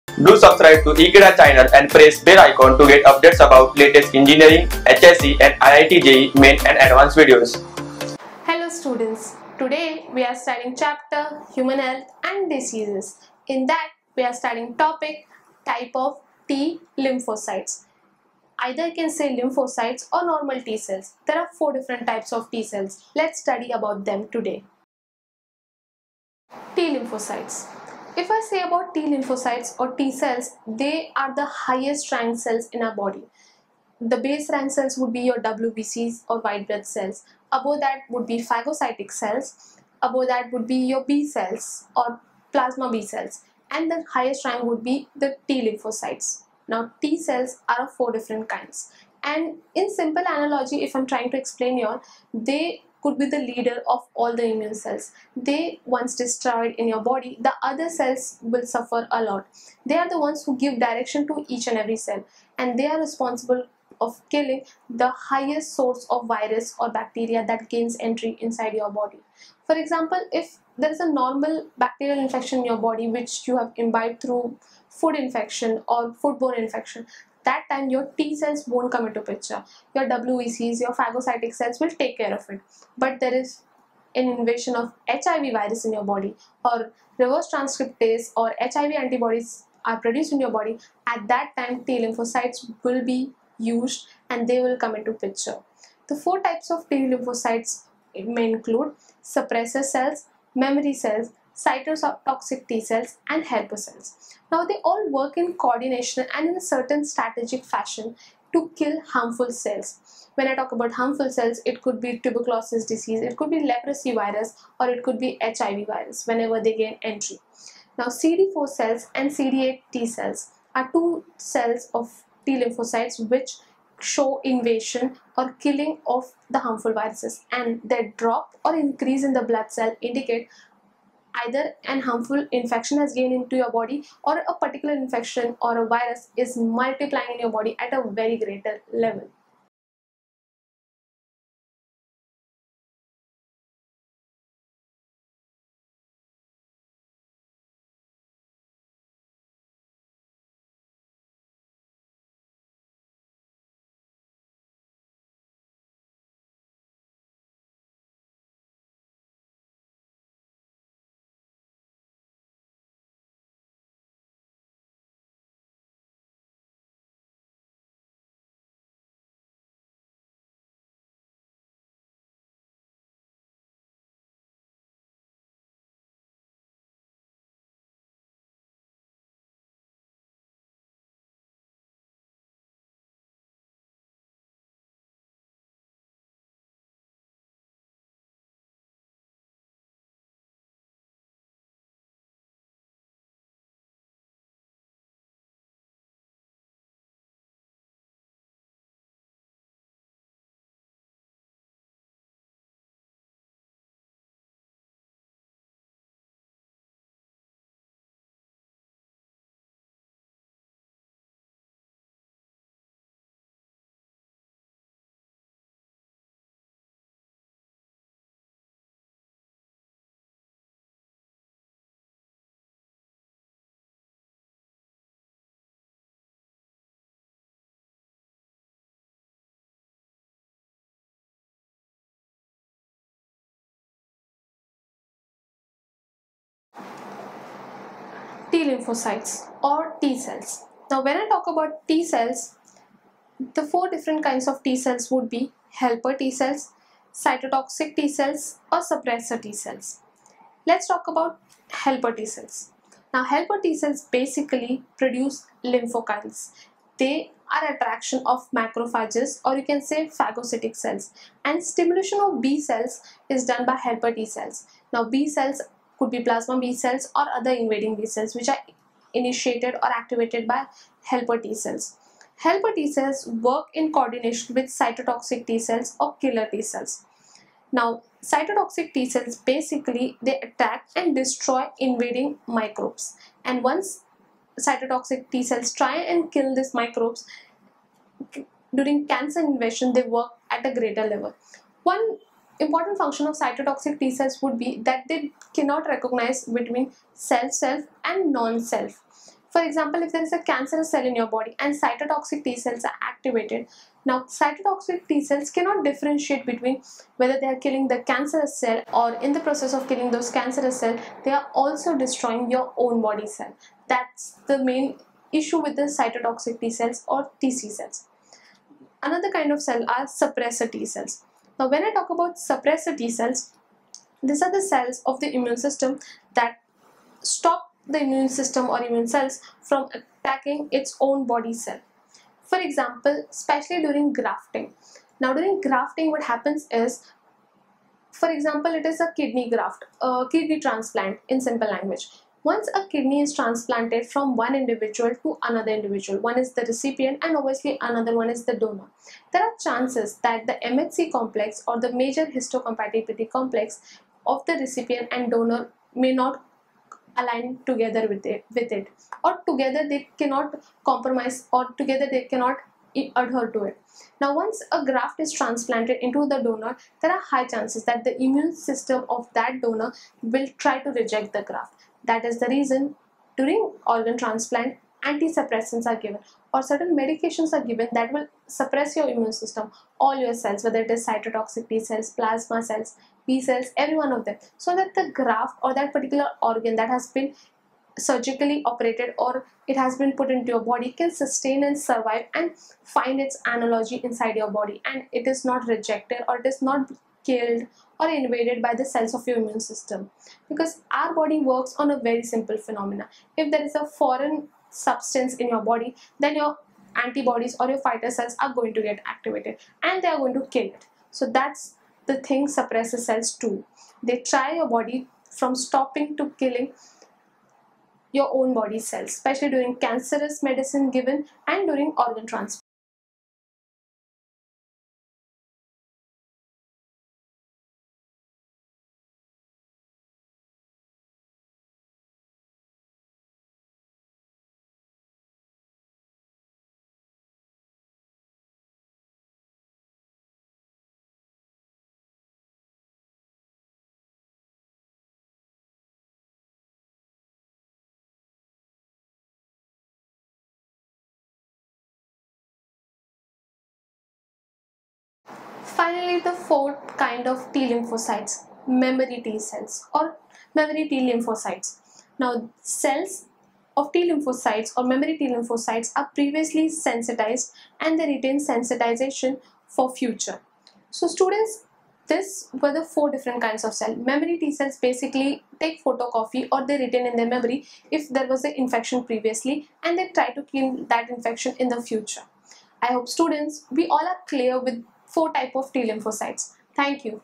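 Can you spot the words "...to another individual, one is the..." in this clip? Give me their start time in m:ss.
5:45.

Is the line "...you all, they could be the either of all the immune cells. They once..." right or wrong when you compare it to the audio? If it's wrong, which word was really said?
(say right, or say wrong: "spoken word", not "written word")
wrong: "leader", not "either".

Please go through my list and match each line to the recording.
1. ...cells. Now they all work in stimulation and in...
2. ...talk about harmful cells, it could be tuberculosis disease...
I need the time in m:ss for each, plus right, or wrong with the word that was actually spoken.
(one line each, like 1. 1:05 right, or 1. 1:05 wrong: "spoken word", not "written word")
1. 1:43 wrong: "coordination", not "stimulation"
2. 1:50 right.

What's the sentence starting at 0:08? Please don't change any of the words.
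Hello students, today we are studying chapter Human Health and Diseases.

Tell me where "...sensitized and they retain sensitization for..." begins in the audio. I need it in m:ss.
7:46.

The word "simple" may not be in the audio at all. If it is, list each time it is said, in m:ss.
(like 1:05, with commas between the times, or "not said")
0:49, 5:41, 6:42.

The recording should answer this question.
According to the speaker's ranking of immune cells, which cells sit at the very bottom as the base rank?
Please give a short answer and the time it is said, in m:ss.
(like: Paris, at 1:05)
White blood cells, at 0:35.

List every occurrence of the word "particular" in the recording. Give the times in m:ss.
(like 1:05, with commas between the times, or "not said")
2:14, 6:25.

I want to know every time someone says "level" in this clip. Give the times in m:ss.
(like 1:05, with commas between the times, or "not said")
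2:18, 4:51.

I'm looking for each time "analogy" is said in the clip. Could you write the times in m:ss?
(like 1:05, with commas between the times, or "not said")
0:50, 6:33.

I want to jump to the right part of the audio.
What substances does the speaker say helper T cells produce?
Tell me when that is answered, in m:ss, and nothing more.
4:15.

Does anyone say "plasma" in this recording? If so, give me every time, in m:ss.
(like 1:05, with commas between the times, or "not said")
0:42, 4:26, 6:22.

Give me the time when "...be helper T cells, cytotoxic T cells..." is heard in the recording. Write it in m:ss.
4:05.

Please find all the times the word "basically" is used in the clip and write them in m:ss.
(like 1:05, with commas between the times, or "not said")
4:14, 4:39, 7:54.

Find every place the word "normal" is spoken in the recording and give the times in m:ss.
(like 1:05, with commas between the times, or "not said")
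0:20, 1:11.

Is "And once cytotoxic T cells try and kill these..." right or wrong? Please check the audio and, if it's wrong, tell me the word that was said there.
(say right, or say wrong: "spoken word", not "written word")
right.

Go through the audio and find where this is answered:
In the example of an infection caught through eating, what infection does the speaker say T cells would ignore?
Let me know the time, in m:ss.
1:16.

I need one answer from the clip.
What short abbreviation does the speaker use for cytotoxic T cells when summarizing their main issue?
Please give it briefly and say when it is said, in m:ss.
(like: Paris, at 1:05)
TC cells, at 5:17.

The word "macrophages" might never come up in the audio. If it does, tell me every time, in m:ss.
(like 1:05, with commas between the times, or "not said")
4:18.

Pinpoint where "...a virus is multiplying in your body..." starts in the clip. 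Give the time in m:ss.
2:15.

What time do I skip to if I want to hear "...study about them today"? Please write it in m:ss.
0:23.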